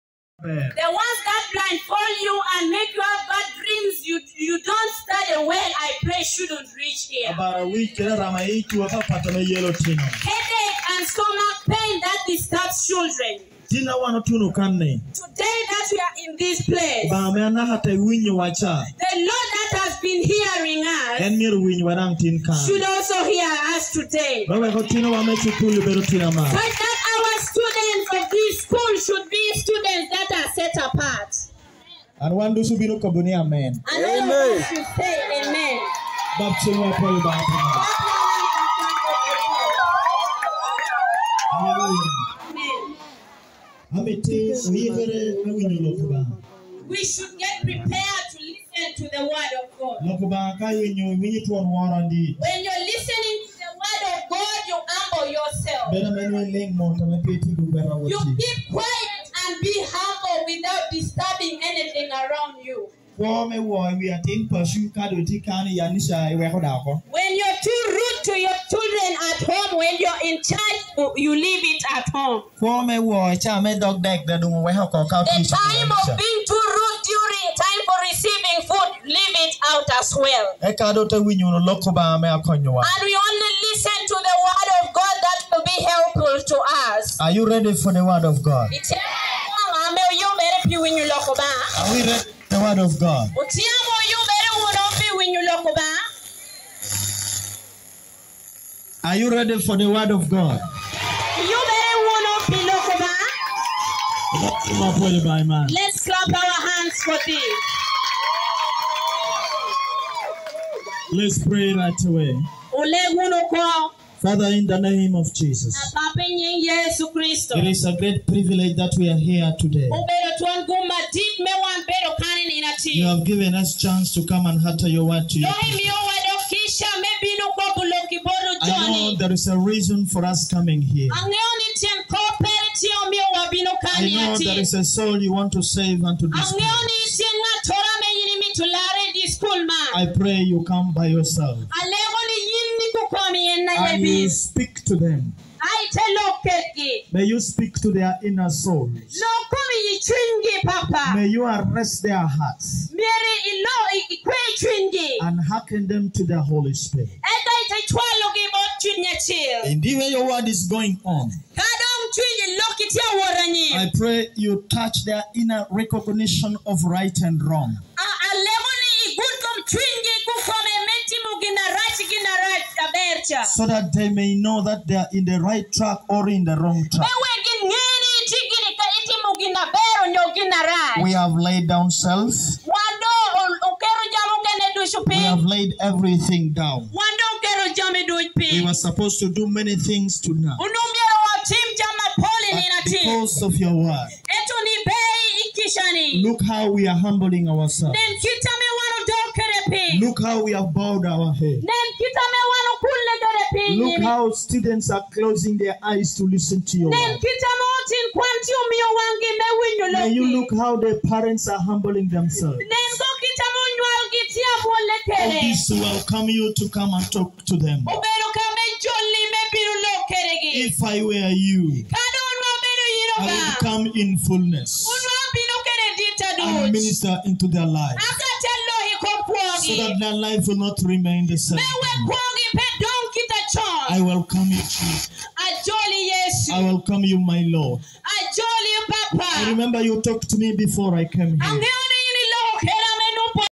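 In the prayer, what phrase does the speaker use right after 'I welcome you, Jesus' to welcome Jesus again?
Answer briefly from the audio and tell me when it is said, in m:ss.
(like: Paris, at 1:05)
Ajoli Yesu, at 3:55.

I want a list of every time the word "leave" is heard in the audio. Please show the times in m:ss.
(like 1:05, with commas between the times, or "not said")
1:11, 1:19.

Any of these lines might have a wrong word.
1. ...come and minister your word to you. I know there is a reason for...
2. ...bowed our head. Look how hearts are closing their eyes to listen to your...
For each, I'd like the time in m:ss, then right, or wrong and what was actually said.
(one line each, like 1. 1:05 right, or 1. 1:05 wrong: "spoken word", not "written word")
1. 2:04 wrong: "utter", not "minister"
2. 3:20 wrong: "students", not "hearts".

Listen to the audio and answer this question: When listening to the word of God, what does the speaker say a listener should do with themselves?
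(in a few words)
Humble yourself.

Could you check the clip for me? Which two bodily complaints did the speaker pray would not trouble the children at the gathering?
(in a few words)
Headache and stomach pain.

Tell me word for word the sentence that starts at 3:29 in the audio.
May you look how their parents are humbling themselves.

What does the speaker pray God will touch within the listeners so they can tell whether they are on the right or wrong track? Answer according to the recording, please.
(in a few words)
Inner recognition of right and wrong.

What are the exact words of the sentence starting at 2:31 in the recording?
May you arrest their hearts and hearken them to the Holy Spirit.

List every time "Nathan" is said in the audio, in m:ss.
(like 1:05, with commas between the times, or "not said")
not said.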